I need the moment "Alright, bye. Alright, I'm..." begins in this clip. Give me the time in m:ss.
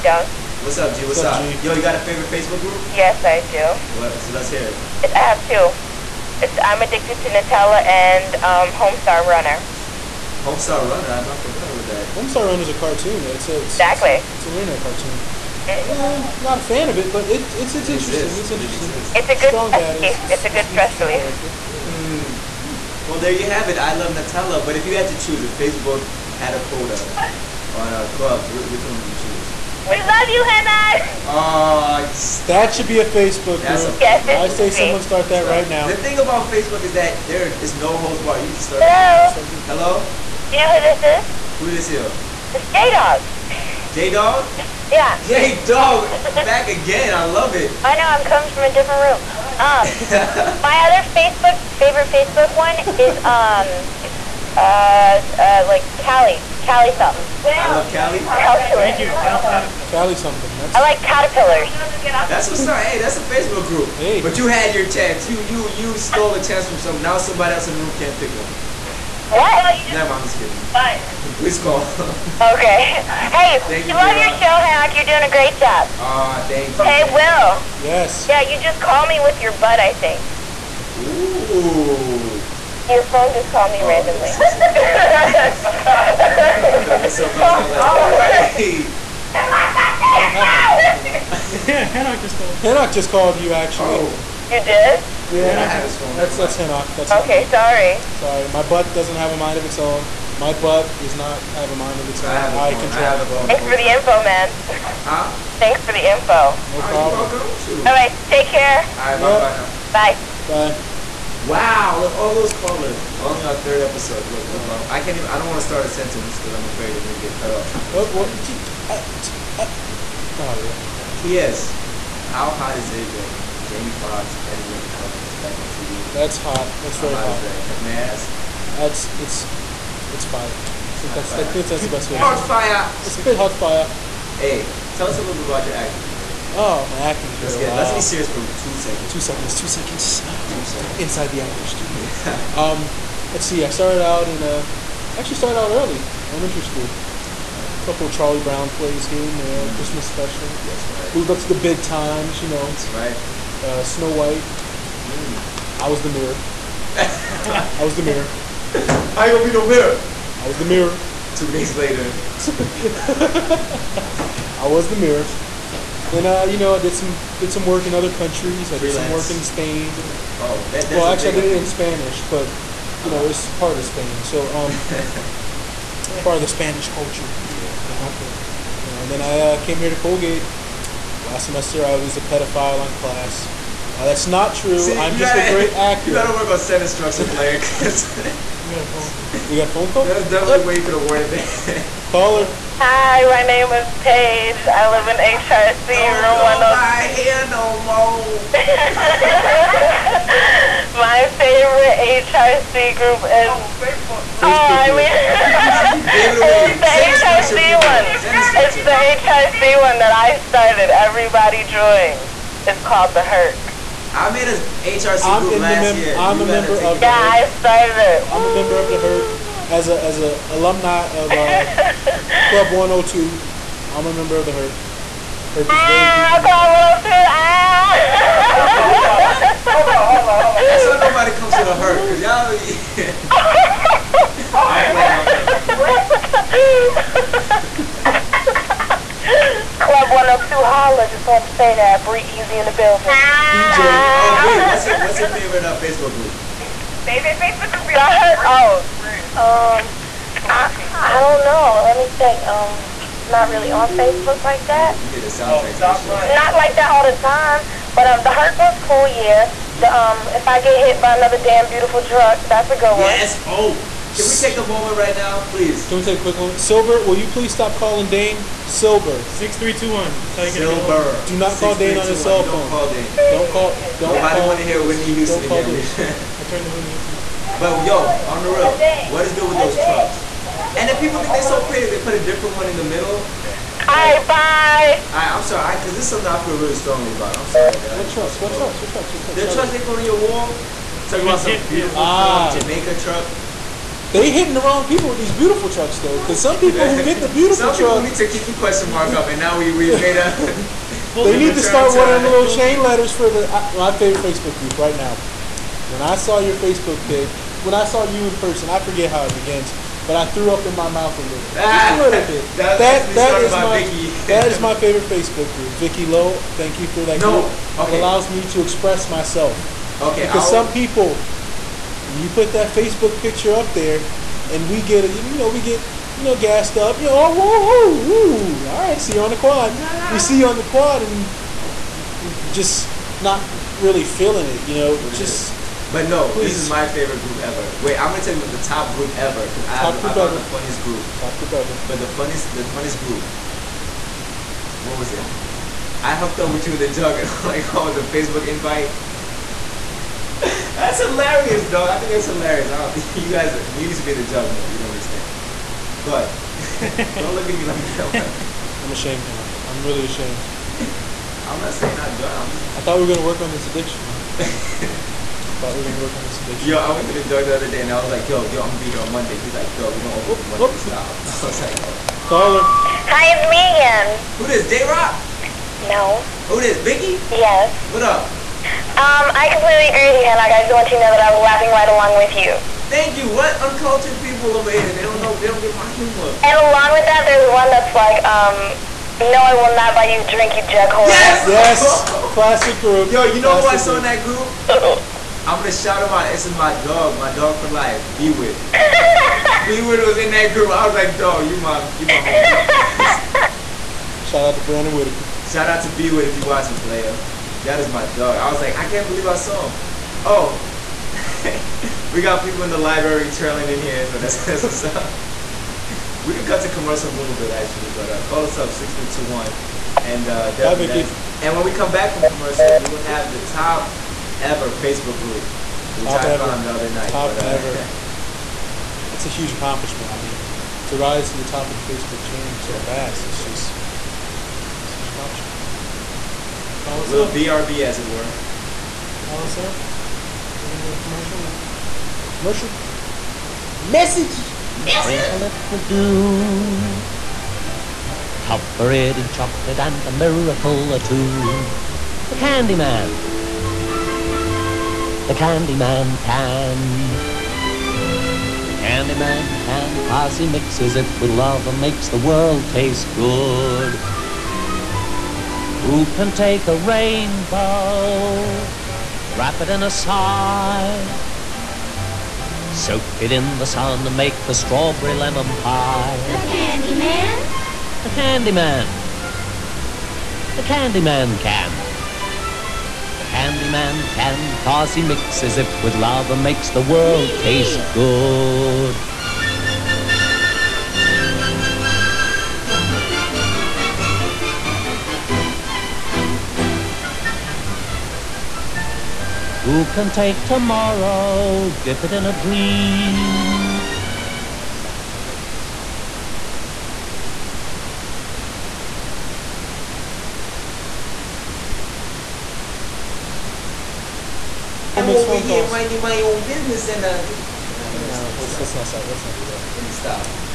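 4:43.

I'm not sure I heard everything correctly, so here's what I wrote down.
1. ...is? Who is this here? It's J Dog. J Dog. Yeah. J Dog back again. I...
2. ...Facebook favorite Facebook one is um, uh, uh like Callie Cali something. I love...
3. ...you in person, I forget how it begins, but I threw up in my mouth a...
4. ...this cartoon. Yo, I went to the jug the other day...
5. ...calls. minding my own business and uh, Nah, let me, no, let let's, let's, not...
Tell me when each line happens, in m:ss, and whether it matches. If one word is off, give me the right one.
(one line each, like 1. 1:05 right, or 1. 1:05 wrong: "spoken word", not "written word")
1. 0:41 right
2. 0:51 right
3. 5:08 right
4. 6:06 wrong: "addiction", not "cartoon"
5. 8:35 right.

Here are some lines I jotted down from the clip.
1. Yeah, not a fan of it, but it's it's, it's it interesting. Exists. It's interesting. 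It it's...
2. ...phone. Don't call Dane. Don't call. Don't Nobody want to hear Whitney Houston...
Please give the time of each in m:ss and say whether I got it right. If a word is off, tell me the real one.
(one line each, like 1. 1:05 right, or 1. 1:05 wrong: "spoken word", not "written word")
1. 0:15 right
2. 4:32 right.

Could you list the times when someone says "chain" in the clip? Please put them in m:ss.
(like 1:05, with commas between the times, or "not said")
5:02, 7:12.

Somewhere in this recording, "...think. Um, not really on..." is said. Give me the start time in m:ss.
4:12.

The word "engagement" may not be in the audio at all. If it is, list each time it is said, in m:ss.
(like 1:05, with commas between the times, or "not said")
not said.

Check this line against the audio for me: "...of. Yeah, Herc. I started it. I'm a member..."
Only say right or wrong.
right.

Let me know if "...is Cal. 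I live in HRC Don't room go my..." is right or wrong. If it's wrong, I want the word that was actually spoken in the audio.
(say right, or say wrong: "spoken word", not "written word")
wrong: "Paige", not "Cal".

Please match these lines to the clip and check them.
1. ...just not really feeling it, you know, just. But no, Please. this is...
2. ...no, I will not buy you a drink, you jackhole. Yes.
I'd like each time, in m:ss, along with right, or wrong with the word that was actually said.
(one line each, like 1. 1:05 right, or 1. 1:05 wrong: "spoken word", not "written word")
1. 5:32 right
2. 6:29 right.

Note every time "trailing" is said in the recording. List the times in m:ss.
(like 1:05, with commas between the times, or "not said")
6:53.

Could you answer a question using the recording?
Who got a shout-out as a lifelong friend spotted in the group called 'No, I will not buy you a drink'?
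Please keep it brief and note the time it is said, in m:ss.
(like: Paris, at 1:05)
Brandon Whitaker, at 6:44.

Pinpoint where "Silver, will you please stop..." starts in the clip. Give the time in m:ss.
4:26.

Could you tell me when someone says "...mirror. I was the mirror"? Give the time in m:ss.
2:39.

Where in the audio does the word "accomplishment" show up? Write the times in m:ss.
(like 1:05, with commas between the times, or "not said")
7:09, 7:15.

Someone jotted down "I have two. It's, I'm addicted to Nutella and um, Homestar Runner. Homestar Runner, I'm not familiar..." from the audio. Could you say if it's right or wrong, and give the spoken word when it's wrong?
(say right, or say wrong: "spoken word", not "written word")
right.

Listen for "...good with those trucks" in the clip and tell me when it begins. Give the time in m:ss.
4:39.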